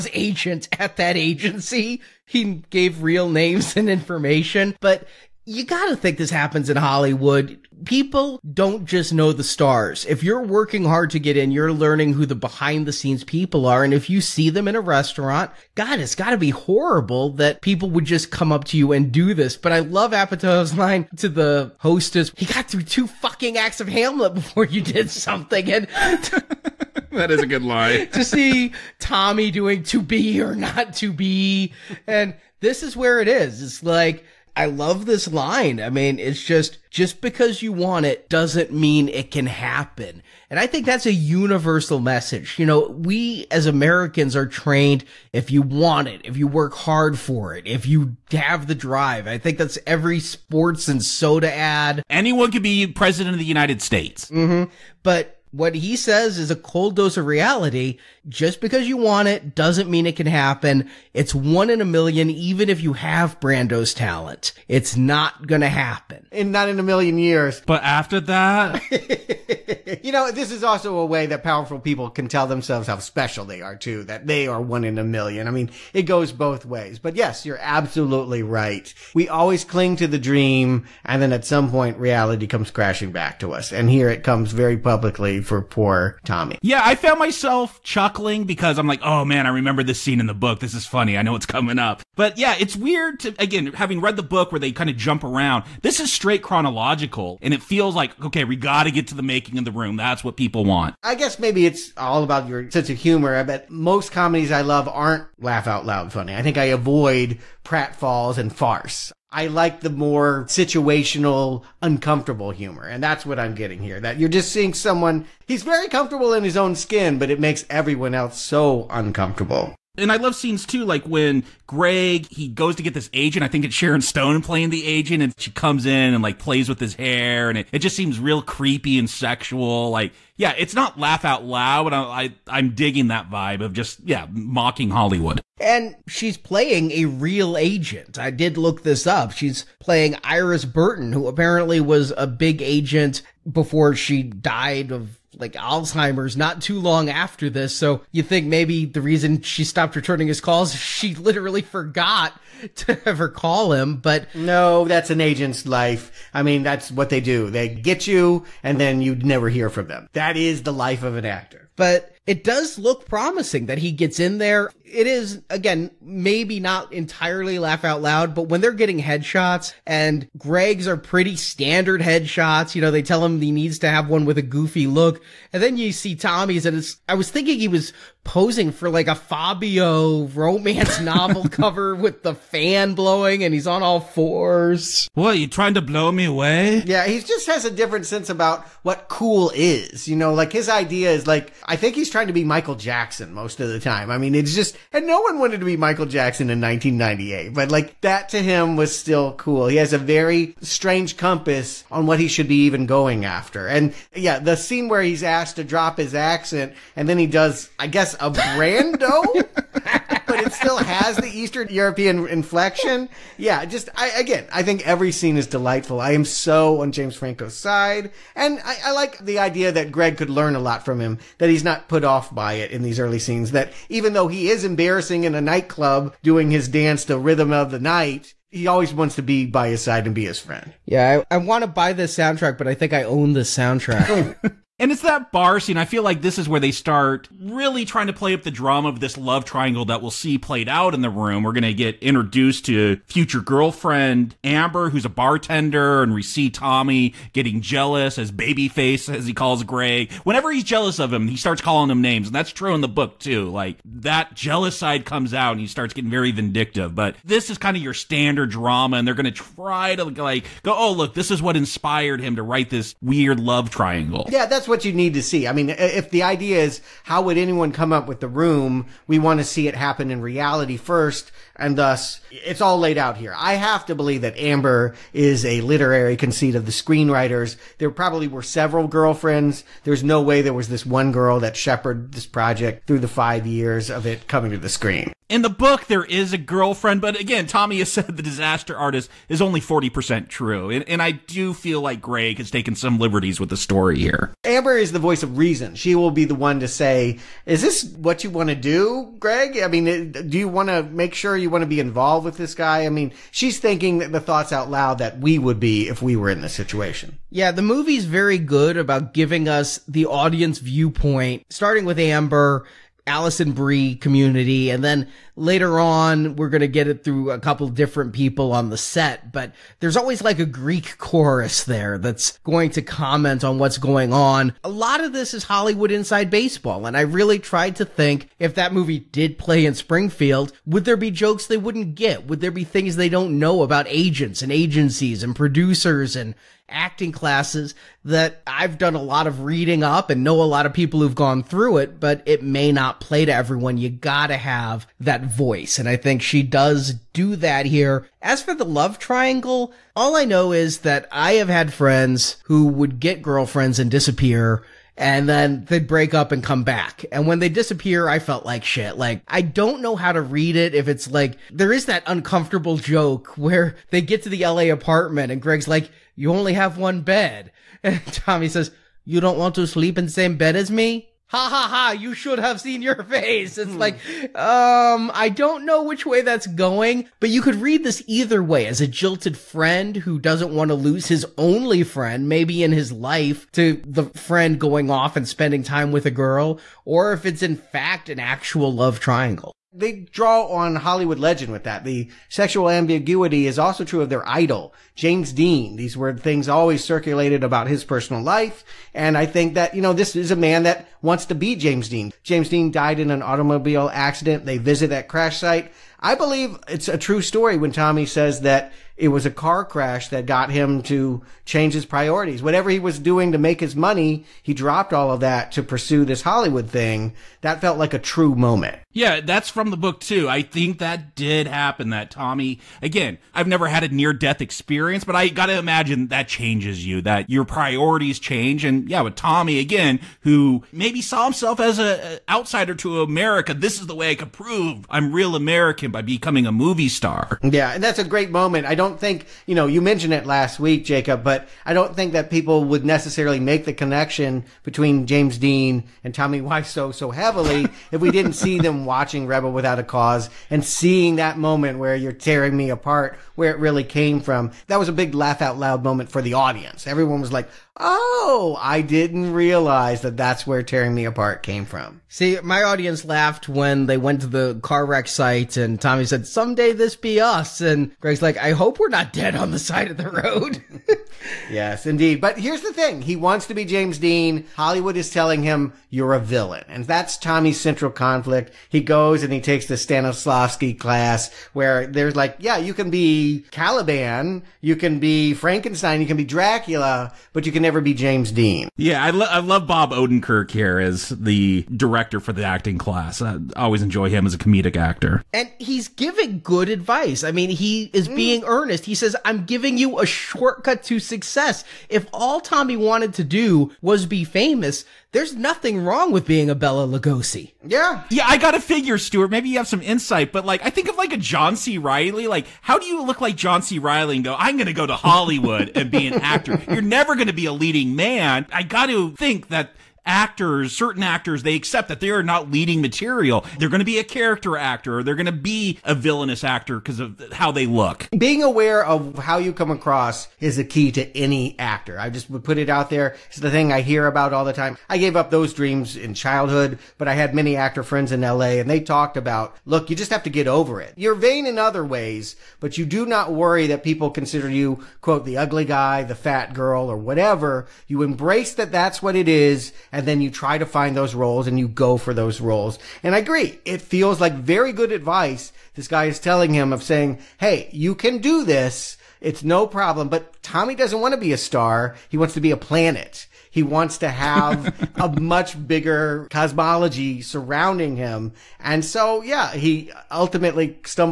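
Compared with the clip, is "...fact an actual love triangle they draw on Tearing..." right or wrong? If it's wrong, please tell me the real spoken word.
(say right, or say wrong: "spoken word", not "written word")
wrong: "Hollywood", not "Tearing".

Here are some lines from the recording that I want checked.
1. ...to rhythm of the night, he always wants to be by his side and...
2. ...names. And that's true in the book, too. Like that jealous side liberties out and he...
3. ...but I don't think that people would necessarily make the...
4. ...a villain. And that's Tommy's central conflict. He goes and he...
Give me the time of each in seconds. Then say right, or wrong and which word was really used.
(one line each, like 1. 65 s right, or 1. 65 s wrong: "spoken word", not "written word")
1. 227 s right
2. 251 s wrong: "comes", not "liberties"
3. 441 s right
4. 476 s right.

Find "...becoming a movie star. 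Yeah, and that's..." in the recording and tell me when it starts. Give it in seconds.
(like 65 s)
436 s.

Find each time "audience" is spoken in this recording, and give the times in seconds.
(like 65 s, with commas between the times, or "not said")
310 s, 456 s, 462 s.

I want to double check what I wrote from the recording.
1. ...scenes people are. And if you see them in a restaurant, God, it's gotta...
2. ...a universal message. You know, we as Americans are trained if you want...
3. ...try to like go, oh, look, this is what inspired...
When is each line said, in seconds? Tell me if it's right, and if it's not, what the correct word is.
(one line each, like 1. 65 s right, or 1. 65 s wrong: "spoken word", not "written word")
1. 12 s right
2. 41 s right
3. 259 s right.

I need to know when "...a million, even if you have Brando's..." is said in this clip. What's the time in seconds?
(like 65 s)
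61 s.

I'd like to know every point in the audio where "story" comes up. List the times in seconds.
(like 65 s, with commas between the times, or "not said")
293 s, 407 s.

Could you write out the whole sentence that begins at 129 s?
Like, yeah, it's not laugh out loud, but I, I am digging that vibe of just yeah mocking Hollywood.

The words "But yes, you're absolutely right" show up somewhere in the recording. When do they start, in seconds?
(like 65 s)
76 s.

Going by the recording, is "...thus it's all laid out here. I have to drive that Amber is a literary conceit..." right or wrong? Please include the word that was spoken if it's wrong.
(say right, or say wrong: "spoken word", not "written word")
wrong: "believe", not "drive".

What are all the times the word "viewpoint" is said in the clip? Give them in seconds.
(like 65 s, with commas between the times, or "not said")
310 s.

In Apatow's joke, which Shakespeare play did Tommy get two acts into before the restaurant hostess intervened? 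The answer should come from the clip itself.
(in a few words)
Hamlet.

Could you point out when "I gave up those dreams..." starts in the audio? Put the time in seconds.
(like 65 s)
534 s.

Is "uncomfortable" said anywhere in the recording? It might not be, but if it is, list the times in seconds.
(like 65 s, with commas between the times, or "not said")
111 s, 118 s, 362 s.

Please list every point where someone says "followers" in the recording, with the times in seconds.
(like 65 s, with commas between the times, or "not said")
not said.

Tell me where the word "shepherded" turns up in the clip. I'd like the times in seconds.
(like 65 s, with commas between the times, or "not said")
281 s.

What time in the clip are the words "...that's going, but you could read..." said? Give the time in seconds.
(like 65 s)
376 s.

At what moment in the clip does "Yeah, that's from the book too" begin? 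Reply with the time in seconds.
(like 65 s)
418 s.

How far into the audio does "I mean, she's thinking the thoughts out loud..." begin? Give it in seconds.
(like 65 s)
302 s.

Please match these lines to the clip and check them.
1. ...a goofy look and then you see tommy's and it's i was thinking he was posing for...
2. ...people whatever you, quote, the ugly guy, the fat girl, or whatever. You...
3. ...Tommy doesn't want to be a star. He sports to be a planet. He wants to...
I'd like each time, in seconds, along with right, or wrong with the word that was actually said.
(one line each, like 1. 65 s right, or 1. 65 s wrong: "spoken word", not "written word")
1. 174 s right
2. 543 s wrong: "consider", not "whatever"
3. 560 s wrong: "wants", not "sports".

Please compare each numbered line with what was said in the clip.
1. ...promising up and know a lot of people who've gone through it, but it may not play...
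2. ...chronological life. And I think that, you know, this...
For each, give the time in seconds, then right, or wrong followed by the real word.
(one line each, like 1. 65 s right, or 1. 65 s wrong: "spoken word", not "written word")
1. 339 s wrong: "reading", not "promising"
2. 397 s wrong: "personal", not "chronological".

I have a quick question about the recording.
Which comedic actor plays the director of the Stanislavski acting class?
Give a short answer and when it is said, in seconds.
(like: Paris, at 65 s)
Bob Odenkirk, at 489 s.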